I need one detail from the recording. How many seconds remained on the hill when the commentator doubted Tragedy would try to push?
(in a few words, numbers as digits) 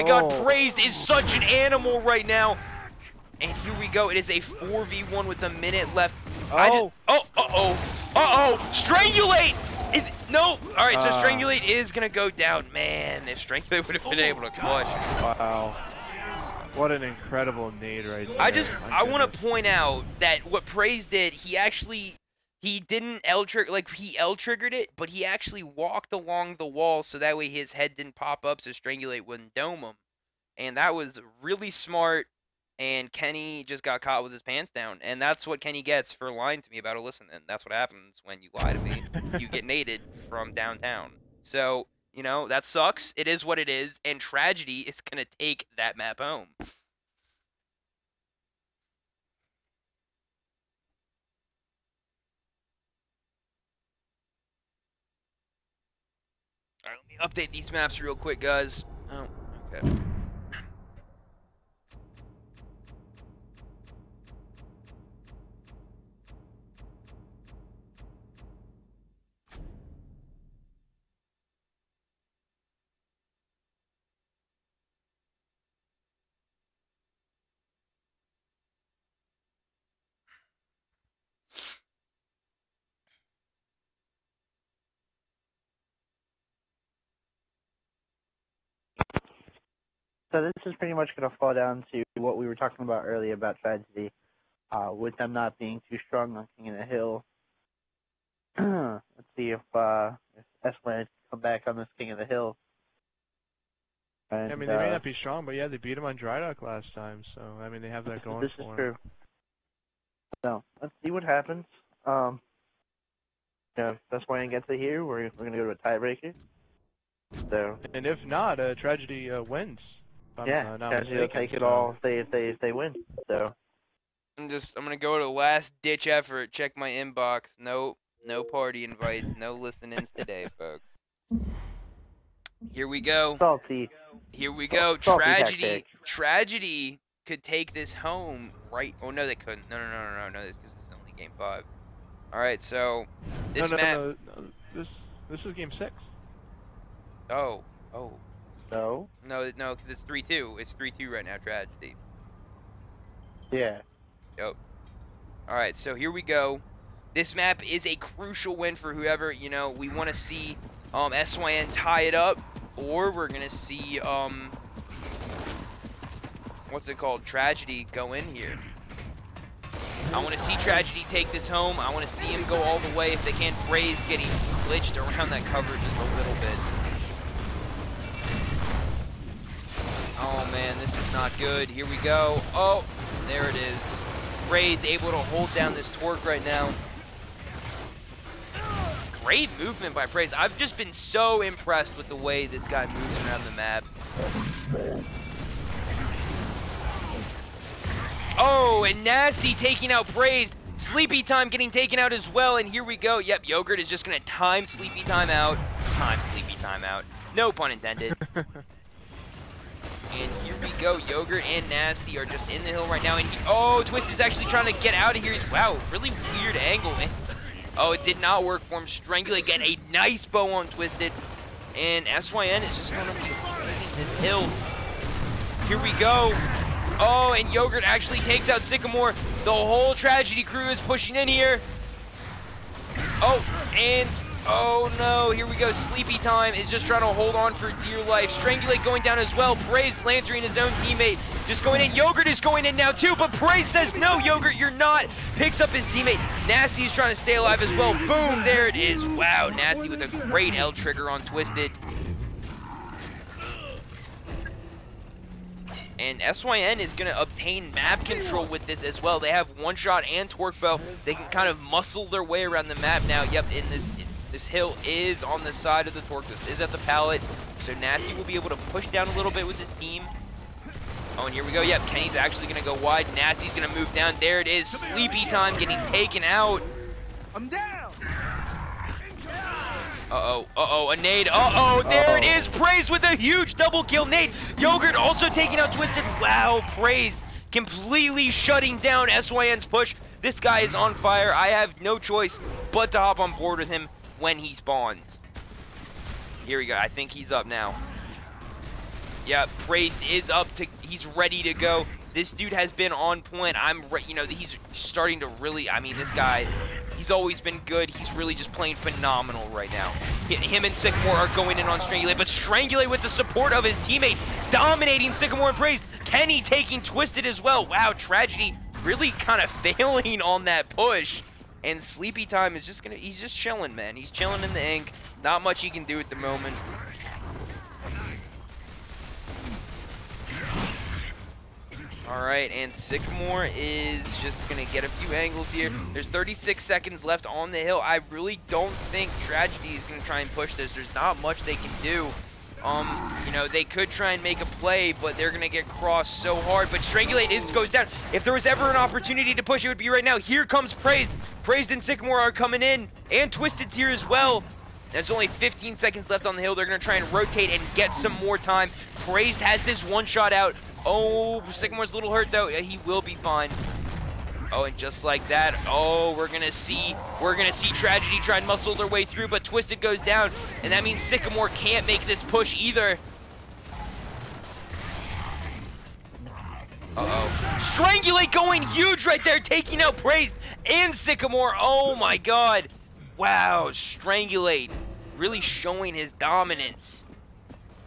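36.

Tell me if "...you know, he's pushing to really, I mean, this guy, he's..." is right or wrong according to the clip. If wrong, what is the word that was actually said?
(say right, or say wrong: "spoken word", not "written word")
wrong: "starting", not "pushing".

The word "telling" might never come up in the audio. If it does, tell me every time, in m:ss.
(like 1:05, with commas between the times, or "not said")
not said.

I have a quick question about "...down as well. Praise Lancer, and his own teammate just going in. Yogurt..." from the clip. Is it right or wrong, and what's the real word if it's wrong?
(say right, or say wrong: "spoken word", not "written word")
right.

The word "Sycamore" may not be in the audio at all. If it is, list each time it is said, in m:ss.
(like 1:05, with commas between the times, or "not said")
3:48, 5:10, 5:15, 5:32, 5:51, 6:01, 6:11, 6:20.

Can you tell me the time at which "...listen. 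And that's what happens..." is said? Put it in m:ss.
0:37.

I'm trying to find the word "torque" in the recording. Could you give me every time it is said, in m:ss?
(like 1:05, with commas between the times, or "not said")
3:05, 4:20, 4:26.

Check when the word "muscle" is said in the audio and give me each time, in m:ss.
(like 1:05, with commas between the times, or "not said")
4:21, 6:08.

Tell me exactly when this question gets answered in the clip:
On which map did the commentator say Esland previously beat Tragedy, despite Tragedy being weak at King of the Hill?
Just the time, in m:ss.
1:46.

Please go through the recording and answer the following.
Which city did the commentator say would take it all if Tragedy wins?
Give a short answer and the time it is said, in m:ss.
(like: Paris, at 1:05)
Chattanooga, at 2:00.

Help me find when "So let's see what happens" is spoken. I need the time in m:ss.
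1:50.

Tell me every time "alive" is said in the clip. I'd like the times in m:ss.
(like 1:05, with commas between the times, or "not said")
4:07.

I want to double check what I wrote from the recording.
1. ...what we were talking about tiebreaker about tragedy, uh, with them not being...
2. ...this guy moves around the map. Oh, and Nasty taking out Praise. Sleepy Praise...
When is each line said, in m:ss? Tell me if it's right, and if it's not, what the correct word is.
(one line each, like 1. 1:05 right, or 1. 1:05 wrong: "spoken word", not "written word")
1. 1:32 wrong: "earlier", not "tiebreaker"
2. 3:12 wrong: "Time", not "Praise".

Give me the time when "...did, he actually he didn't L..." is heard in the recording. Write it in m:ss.
0:21.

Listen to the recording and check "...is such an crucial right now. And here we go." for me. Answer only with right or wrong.
wrong.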